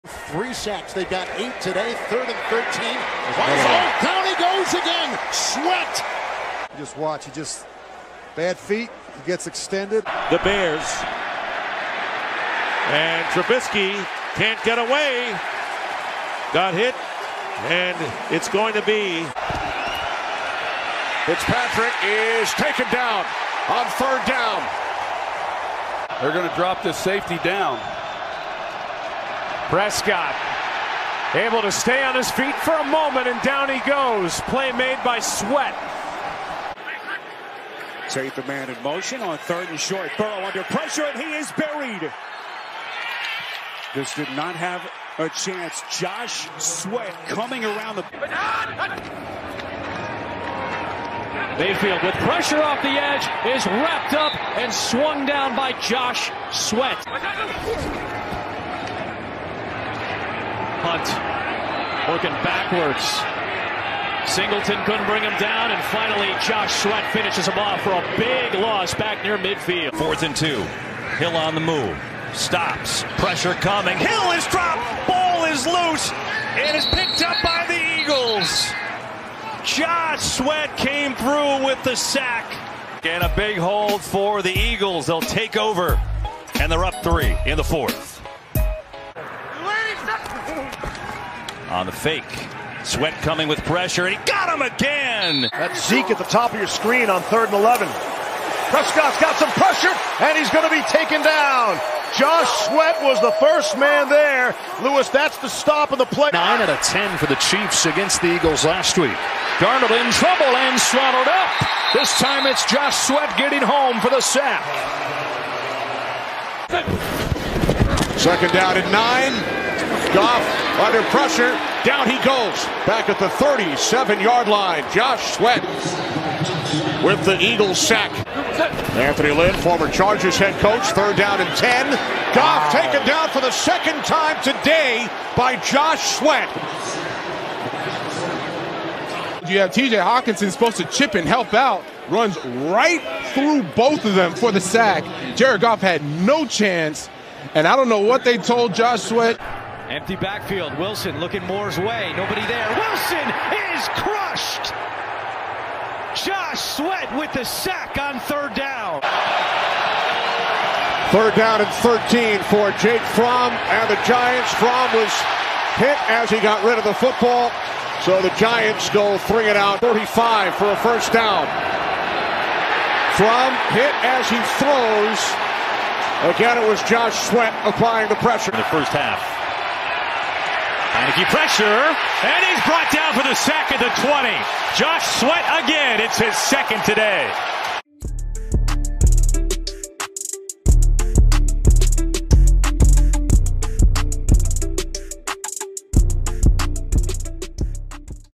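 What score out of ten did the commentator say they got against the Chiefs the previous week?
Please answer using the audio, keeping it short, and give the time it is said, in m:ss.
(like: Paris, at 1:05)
9, at 1:46.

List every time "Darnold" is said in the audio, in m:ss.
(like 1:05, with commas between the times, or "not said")
1:49.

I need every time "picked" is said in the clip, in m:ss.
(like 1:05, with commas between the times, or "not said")
1:16.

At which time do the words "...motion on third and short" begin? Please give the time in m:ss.
0:38.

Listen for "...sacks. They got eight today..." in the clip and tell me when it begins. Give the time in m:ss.
0:00.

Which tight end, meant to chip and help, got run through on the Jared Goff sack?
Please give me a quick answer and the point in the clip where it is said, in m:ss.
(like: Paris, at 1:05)
TJ Hockenson, at 2:19.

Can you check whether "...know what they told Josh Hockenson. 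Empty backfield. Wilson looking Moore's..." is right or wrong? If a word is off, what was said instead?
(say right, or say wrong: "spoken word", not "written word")
wrong: "Sweat", not "Hockenson".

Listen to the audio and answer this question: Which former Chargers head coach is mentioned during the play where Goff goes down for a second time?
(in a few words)
Anthony Lynn.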